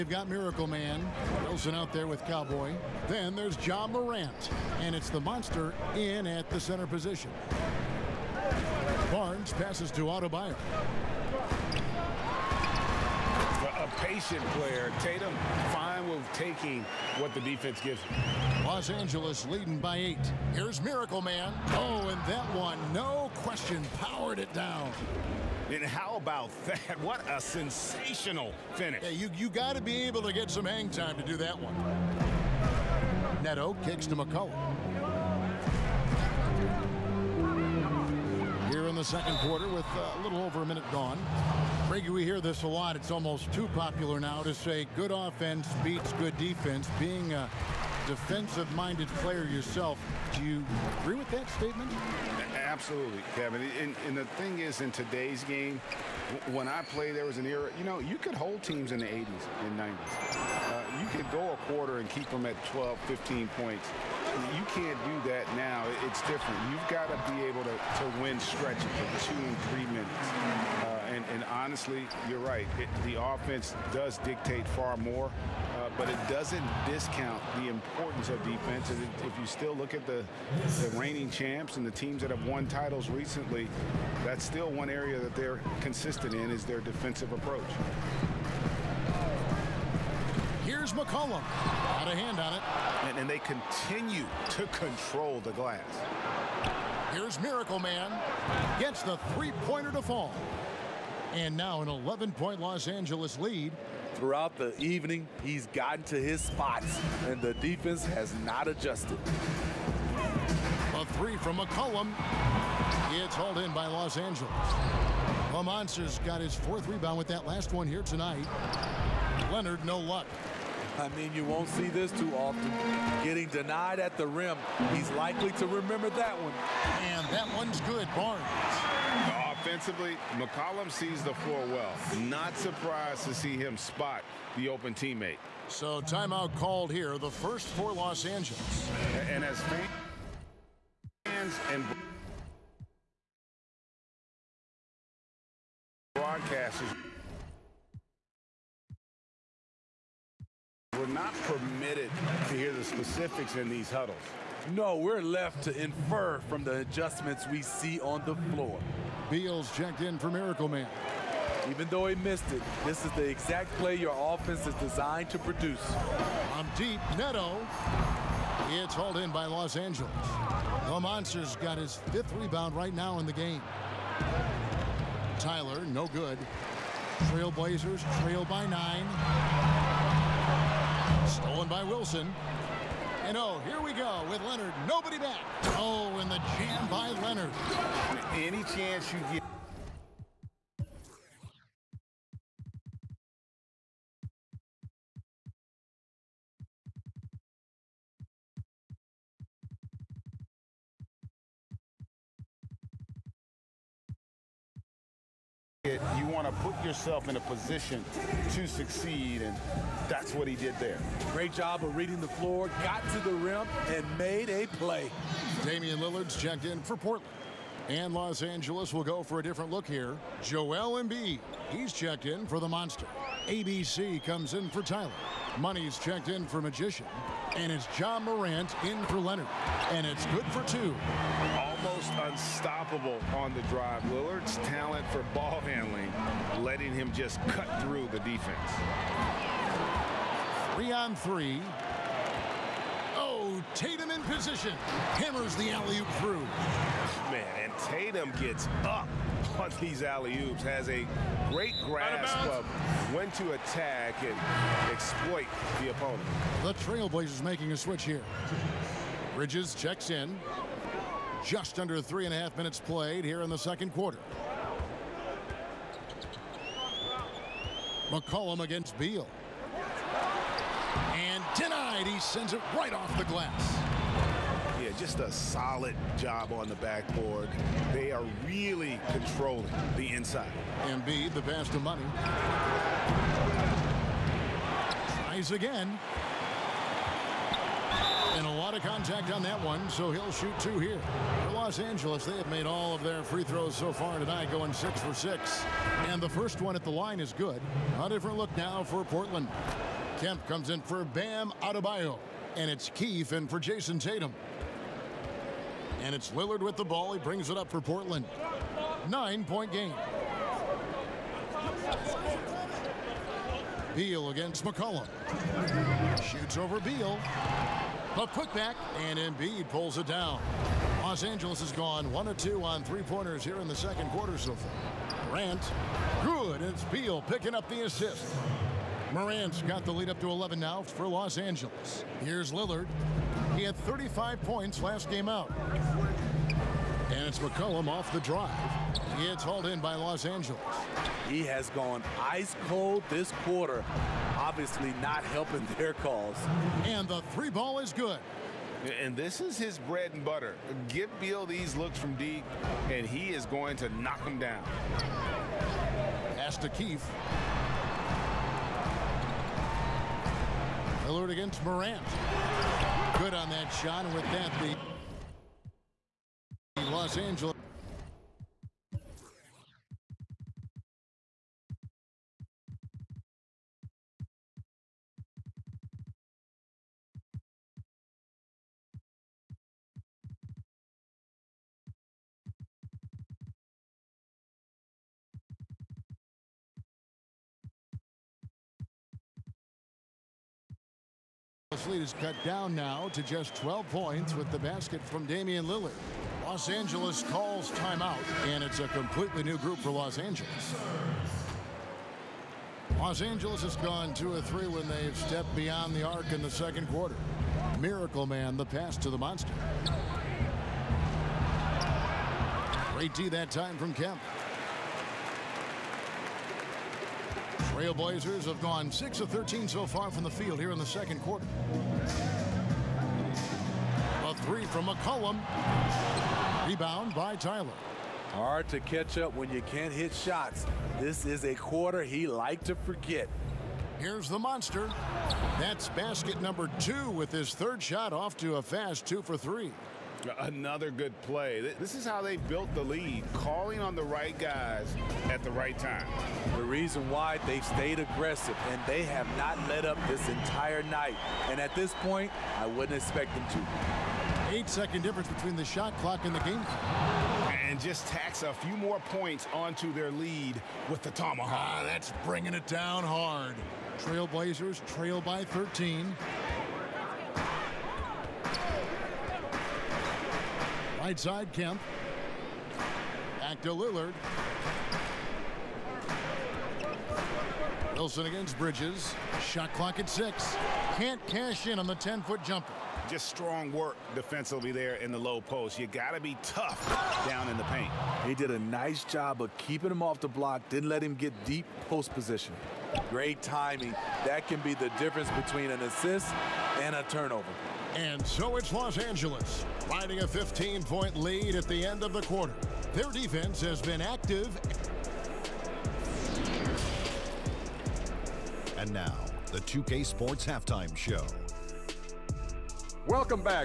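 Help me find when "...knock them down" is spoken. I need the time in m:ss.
5:54.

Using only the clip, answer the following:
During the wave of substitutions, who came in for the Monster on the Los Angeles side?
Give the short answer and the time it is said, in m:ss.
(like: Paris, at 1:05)
Joel Embiid, at 3:40.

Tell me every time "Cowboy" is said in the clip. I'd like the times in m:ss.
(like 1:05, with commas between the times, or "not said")
0:02.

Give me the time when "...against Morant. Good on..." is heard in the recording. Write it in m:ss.
6:01.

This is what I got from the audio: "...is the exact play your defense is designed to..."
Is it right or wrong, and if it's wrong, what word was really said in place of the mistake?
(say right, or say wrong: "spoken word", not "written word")
wrong: "offense", not "defense".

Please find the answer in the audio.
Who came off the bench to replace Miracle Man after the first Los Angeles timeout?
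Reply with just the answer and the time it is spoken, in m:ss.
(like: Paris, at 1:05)
Beals, at 2:39.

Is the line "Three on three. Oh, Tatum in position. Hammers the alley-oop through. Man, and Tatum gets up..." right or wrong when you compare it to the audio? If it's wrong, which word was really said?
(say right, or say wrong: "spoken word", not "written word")
right.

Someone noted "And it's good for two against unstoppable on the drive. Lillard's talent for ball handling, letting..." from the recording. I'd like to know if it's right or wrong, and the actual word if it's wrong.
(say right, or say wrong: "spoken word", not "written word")
wrong: "almost", not "against".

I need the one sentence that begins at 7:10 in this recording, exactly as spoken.
This is a quarter he liked to forget.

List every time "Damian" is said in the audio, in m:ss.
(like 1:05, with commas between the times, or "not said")
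3:35, 6:35.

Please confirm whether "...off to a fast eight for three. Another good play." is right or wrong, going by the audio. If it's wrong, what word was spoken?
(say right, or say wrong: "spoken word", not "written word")
wrong: "two", not "eight".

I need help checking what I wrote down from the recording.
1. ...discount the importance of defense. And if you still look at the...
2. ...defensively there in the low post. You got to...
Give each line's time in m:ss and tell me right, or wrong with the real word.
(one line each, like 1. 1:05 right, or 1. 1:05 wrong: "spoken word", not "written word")
1. 1:16 right
2. 8:04 right.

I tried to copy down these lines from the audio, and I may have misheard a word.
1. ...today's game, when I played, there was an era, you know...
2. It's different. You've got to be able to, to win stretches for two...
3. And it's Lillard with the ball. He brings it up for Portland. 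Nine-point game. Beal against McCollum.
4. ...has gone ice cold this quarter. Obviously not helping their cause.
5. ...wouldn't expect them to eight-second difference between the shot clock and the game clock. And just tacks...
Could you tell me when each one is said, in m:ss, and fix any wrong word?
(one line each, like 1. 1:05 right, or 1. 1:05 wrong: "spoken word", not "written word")
1. 0:54 right
2. 1:06 right
3. 5:06 right
4. 5:41 right
5. 7:32 right.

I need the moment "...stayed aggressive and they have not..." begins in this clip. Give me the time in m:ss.
7:27.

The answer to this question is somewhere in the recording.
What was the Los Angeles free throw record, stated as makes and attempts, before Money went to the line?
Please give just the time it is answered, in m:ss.
4:54.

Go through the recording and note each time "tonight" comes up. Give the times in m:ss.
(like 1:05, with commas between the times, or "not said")
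1:58, 4:54.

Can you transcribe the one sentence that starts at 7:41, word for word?
Ah, that's bringing it down hard.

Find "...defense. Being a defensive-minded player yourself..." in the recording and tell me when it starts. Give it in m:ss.
0:46.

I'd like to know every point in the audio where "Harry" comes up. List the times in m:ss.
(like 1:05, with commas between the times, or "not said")
not said.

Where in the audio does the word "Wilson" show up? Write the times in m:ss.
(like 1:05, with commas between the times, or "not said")
0:01, 3:01, 7:57.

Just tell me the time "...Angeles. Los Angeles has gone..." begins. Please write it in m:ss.
6:40.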